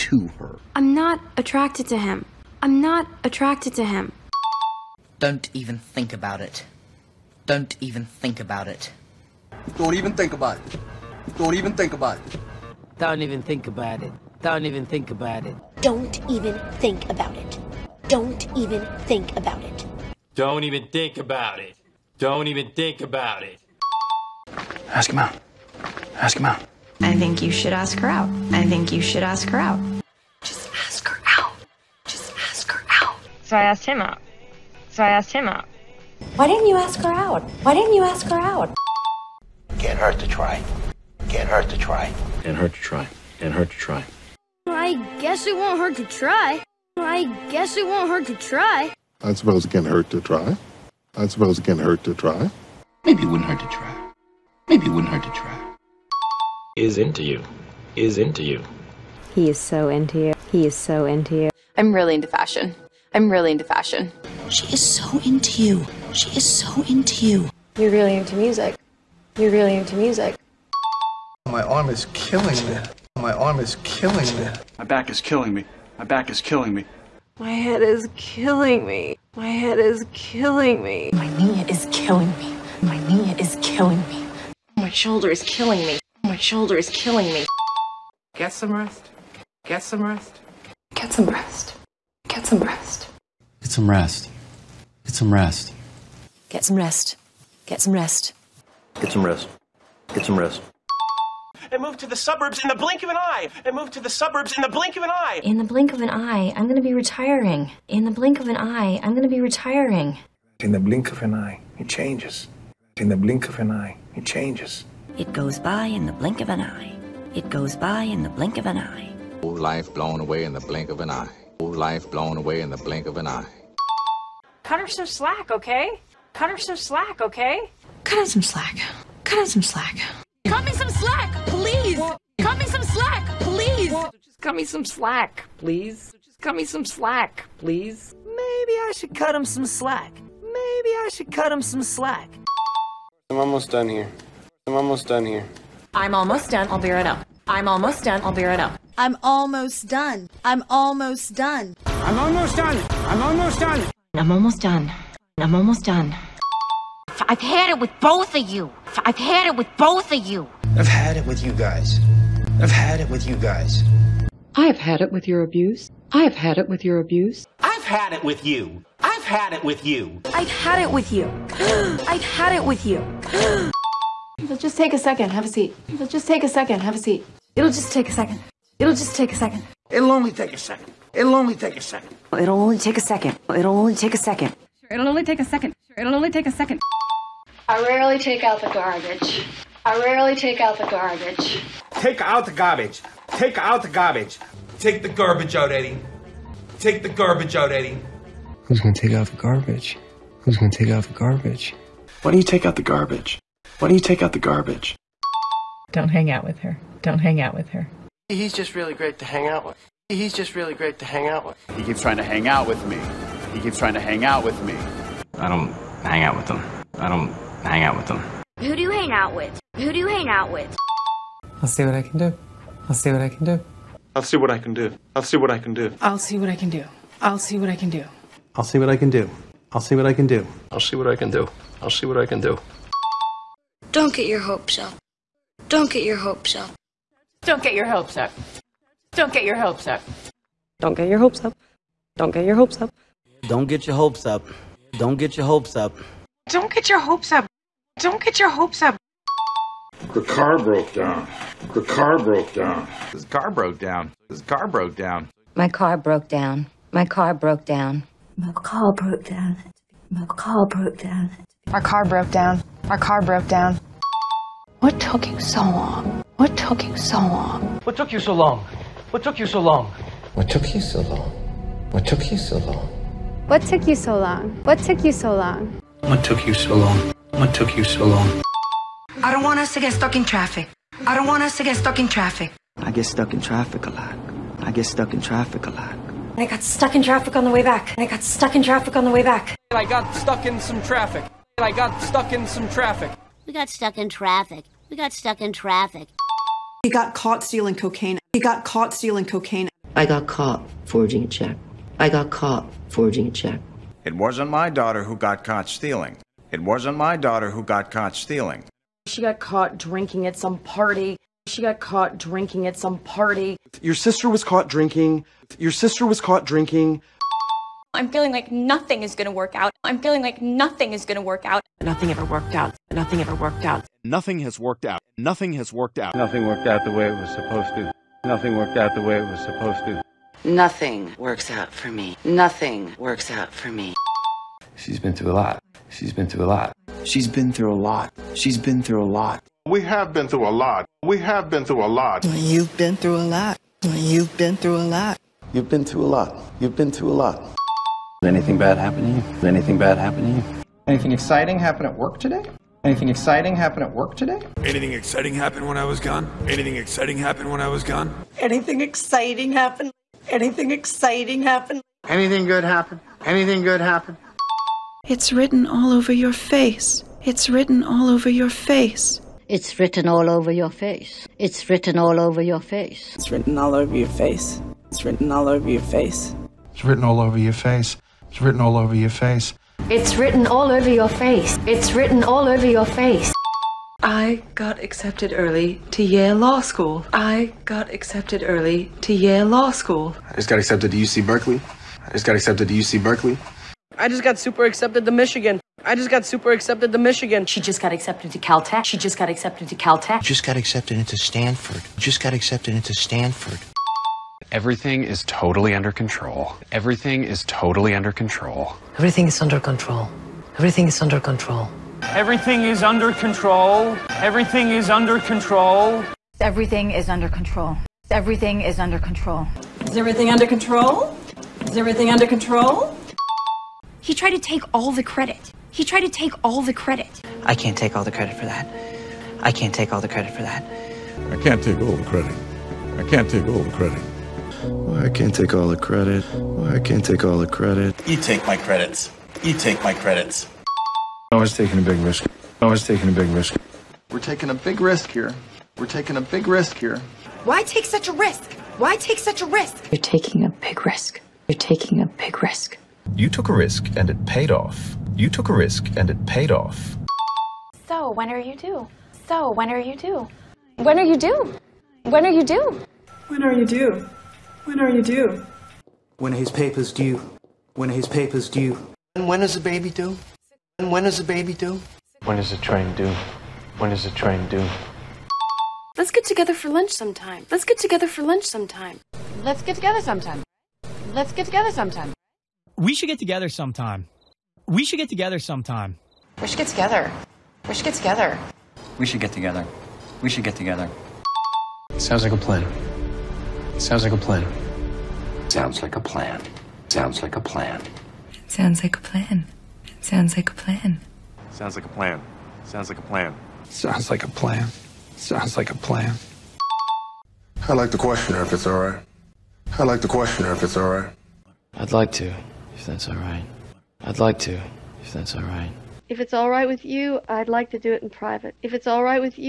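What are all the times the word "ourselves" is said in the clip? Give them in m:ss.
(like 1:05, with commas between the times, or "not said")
not said.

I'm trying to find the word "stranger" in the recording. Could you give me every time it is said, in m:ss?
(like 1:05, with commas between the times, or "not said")
not said.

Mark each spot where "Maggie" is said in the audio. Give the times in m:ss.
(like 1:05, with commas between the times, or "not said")
not said.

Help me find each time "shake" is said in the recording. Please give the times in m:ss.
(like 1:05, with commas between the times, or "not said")
not said.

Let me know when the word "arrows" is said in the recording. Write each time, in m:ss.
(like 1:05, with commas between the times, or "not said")
not said.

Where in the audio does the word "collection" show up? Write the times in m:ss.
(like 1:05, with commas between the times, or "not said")
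not said.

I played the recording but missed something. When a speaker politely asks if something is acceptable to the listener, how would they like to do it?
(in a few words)
in private.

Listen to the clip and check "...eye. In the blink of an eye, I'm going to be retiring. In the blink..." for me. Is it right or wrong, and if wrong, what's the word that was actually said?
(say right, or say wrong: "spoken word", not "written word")
right.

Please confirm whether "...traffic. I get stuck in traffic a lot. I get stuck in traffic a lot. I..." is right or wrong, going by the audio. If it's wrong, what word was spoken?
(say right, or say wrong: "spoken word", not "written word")
right.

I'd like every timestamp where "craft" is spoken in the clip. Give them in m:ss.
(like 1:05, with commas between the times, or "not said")
not said.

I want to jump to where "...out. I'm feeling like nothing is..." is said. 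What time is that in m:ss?
5:19.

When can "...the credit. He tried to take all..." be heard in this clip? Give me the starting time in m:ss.
7:04.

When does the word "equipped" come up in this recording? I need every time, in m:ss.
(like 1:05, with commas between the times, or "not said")
not said.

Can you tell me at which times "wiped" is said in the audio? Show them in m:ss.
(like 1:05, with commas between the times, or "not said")
not said.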